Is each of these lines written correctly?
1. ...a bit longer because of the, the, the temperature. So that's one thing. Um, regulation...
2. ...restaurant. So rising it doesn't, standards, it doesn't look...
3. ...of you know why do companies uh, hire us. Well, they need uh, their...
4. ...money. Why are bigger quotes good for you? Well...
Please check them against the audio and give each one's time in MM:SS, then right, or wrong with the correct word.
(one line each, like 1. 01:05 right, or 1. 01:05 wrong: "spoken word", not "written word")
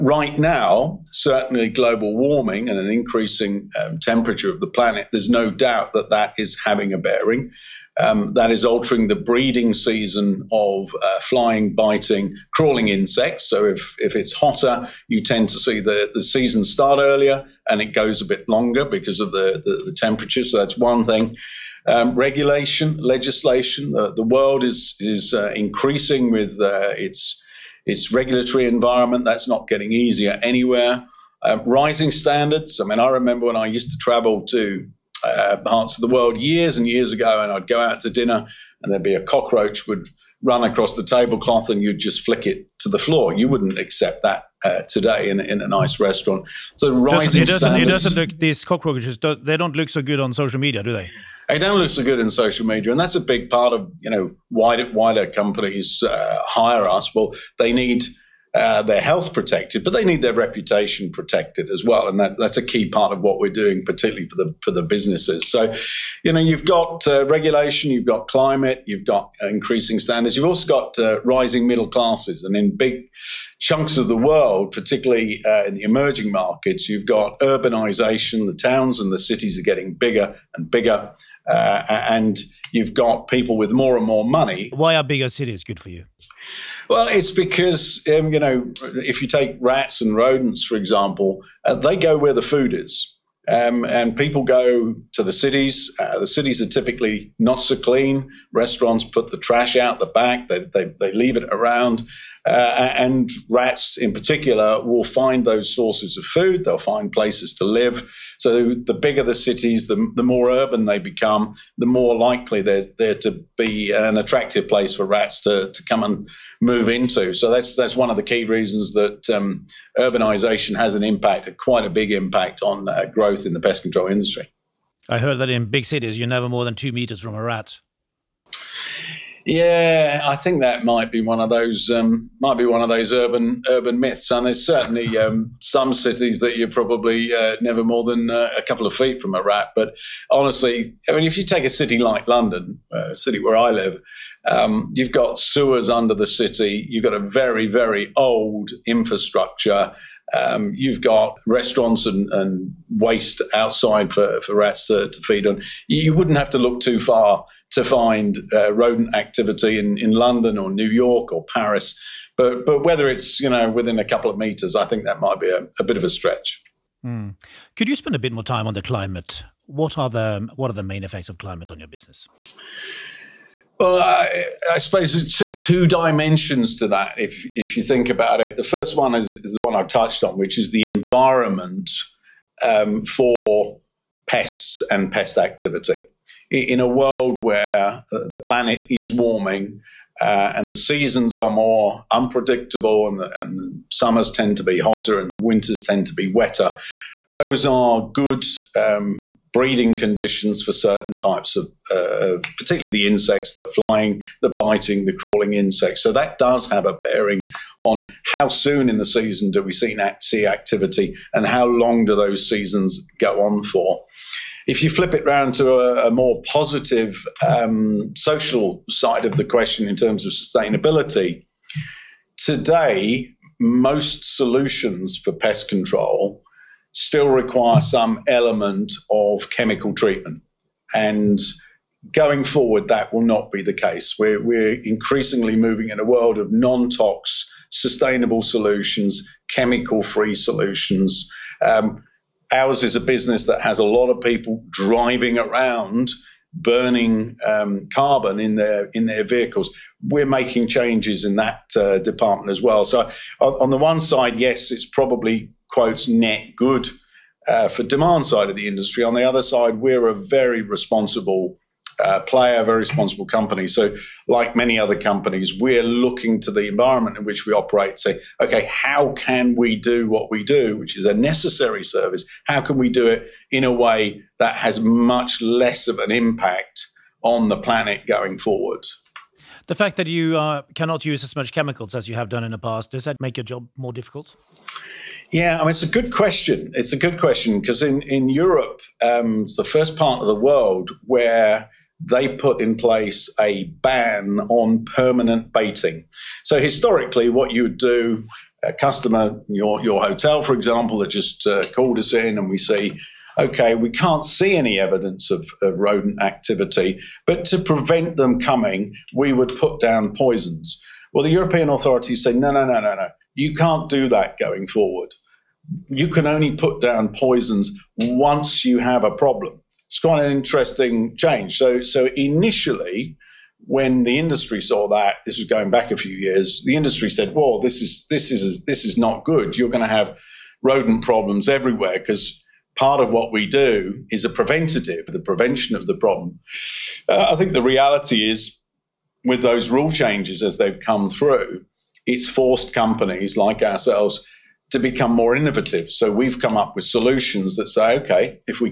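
1. 00:18 right
2. 00:45 right
3. 00:53 right
4. 01:24 wrong: "cities", not "quotes".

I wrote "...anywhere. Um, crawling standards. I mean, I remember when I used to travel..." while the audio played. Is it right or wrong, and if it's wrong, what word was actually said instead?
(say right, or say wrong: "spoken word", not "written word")
wrong: "rising", not "crawling".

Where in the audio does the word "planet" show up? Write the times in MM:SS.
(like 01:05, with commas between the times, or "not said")
00:04, 03:08, 04:37.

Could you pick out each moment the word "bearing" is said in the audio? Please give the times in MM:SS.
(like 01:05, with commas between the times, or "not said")
00:06, 03:26.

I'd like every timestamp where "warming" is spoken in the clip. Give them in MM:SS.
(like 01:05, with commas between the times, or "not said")
00:02, 03:09.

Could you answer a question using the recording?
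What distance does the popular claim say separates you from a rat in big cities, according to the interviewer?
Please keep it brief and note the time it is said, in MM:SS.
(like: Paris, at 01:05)
2 meters, at 02:06.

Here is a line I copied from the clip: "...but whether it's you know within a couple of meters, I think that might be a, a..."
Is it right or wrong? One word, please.
right.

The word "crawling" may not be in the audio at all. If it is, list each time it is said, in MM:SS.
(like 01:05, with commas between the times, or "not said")
00:12, 03:25.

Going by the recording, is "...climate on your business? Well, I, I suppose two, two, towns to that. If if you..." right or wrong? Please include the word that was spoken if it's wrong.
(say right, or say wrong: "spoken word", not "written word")
wrong: "dimensions", not "towns".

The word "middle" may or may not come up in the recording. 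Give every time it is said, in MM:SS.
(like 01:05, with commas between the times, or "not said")
01:11.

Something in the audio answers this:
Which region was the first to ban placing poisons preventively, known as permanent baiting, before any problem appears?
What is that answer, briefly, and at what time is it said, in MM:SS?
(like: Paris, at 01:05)
Europe, at 04:48.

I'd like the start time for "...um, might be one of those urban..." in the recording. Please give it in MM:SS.
02:11.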